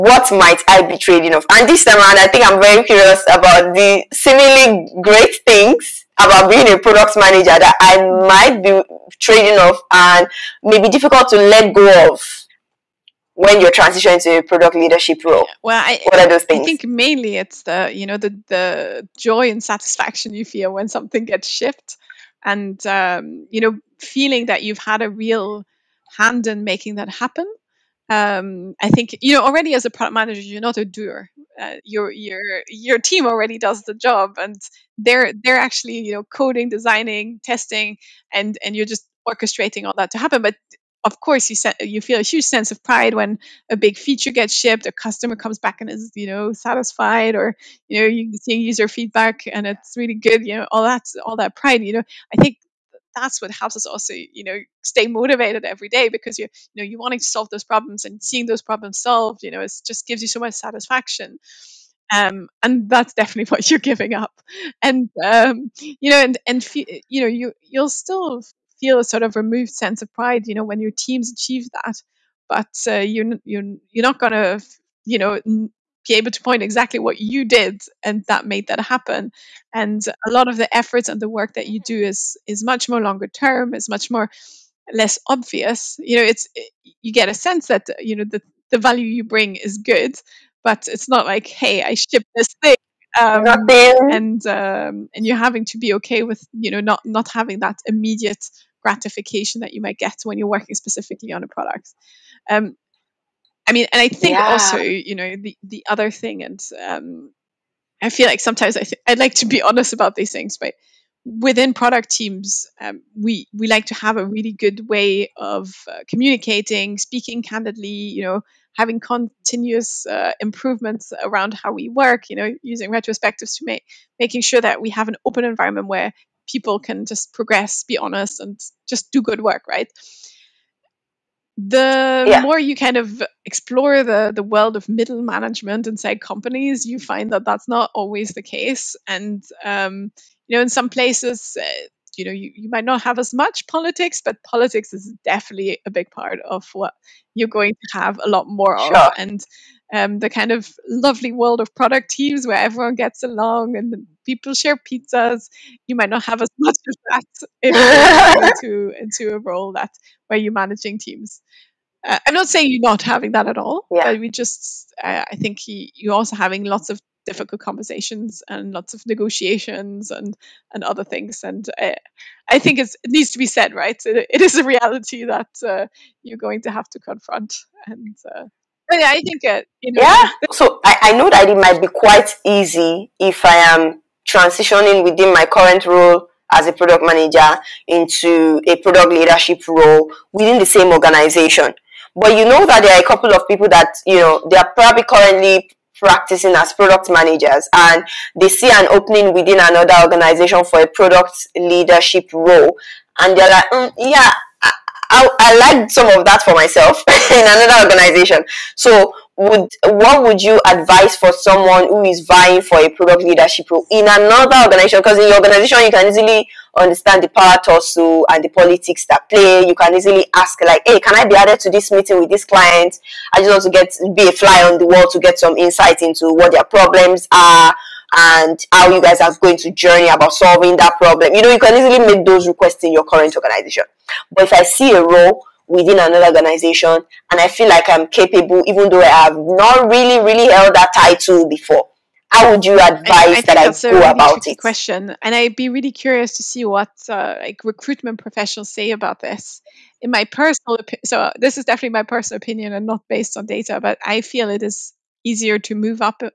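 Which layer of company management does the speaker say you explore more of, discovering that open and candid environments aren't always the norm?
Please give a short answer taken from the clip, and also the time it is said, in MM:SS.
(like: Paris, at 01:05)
Middle management, at 02:14.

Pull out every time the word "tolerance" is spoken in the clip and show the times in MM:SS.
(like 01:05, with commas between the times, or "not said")
not said.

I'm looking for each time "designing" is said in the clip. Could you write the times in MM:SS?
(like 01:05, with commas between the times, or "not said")
00:36.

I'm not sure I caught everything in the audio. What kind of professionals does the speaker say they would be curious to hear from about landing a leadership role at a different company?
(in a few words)
Recruitment professionals.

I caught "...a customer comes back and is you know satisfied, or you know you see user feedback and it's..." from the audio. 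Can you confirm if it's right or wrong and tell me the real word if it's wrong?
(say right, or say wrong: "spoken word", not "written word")
right.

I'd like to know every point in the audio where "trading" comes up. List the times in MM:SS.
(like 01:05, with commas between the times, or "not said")
00:00, 00:09.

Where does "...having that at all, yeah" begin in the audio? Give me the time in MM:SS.
02:43.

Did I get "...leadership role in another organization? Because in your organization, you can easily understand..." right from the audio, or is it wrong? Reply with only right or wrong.
right.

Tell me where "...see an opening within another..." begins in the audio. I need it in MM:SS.
03:18.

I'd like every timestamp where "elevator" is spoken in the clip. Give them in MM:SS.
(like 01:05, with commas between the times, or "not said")
not said.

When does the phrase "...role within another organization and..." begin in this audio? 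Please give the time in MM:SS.
03:55.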